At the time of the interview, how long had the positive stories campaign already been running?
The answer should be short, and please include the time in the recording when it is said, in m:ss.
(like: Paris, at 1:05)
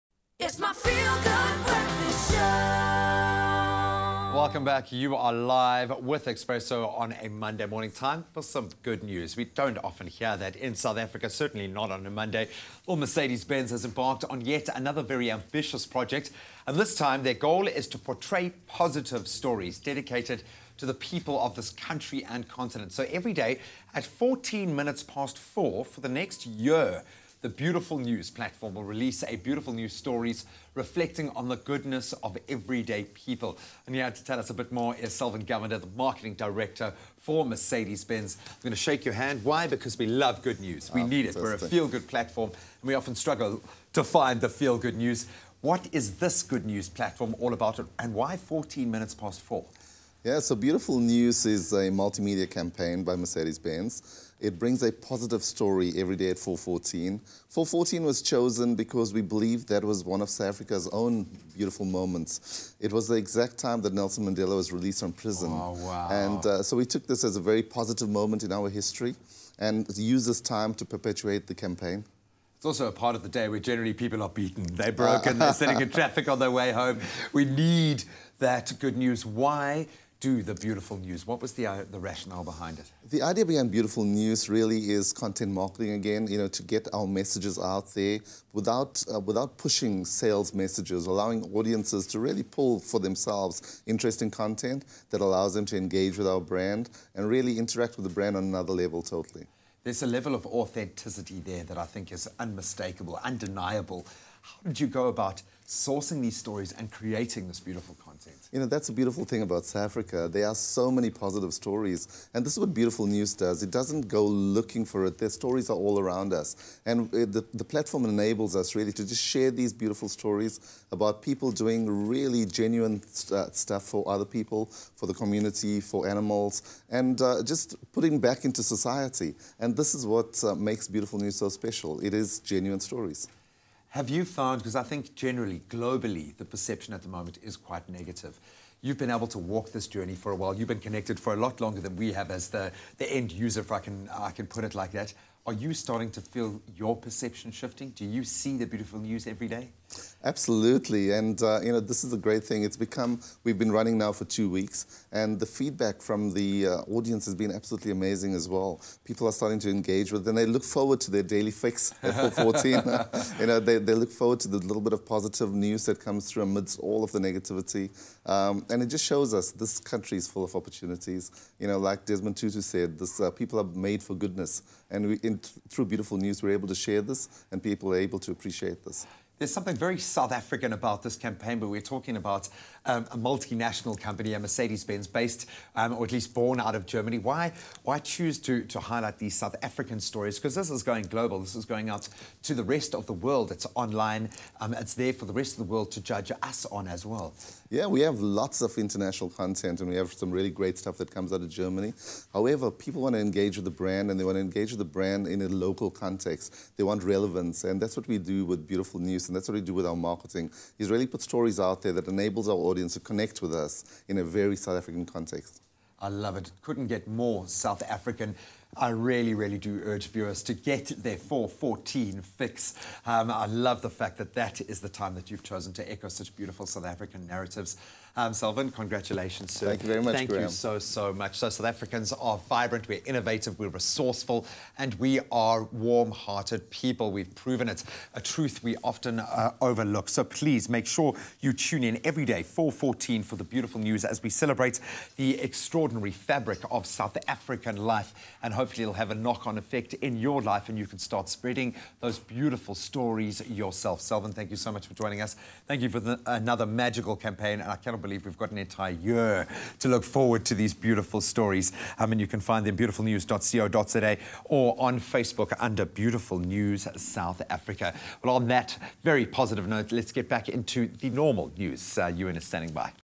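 2 weeks, at 2:34.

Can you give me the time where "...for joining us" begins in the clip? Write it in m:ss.
4:14.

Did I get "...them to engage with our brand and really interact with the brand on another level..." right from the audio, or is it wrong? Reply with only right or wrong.
right.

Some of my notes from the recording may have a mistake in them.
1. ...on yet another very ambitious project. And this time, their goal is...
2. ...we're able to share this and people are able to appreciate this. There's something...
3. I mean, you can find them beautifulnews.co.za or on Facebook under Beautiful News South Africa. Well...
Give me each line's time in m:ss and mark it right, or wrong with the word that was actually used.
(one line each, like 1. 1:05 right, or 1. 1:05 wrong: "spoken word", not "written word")
1. 0:14 right
2. 2:56 right
3. 4:21 right.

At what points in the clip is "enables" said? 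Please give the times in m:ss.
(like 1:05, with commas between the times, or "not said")
1:58, 3:32.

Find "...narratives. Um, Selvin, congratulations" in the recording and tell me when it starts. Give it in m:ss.
3:47.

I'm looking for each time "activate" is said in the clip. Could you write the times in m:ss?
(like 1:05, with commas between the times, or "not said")
not said.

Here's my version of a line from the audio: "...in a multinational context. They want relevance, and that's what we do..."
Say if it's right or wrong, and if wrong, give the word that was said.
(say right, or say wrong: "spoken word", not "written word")
wrong: "local", not "multinational".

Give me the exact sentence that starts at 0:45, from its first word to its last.
What is this good news platform all about, and why 14 minutes past four?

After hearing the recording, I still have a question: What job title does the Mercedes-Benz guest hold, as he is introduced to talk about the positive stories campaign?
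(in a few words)
Marketing director.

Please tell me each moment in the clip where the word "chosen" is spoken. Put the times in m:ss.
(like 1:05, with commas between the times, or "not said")
0:58, 3:45.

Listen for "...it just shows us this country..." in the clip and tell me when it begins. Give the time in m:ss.
2:48.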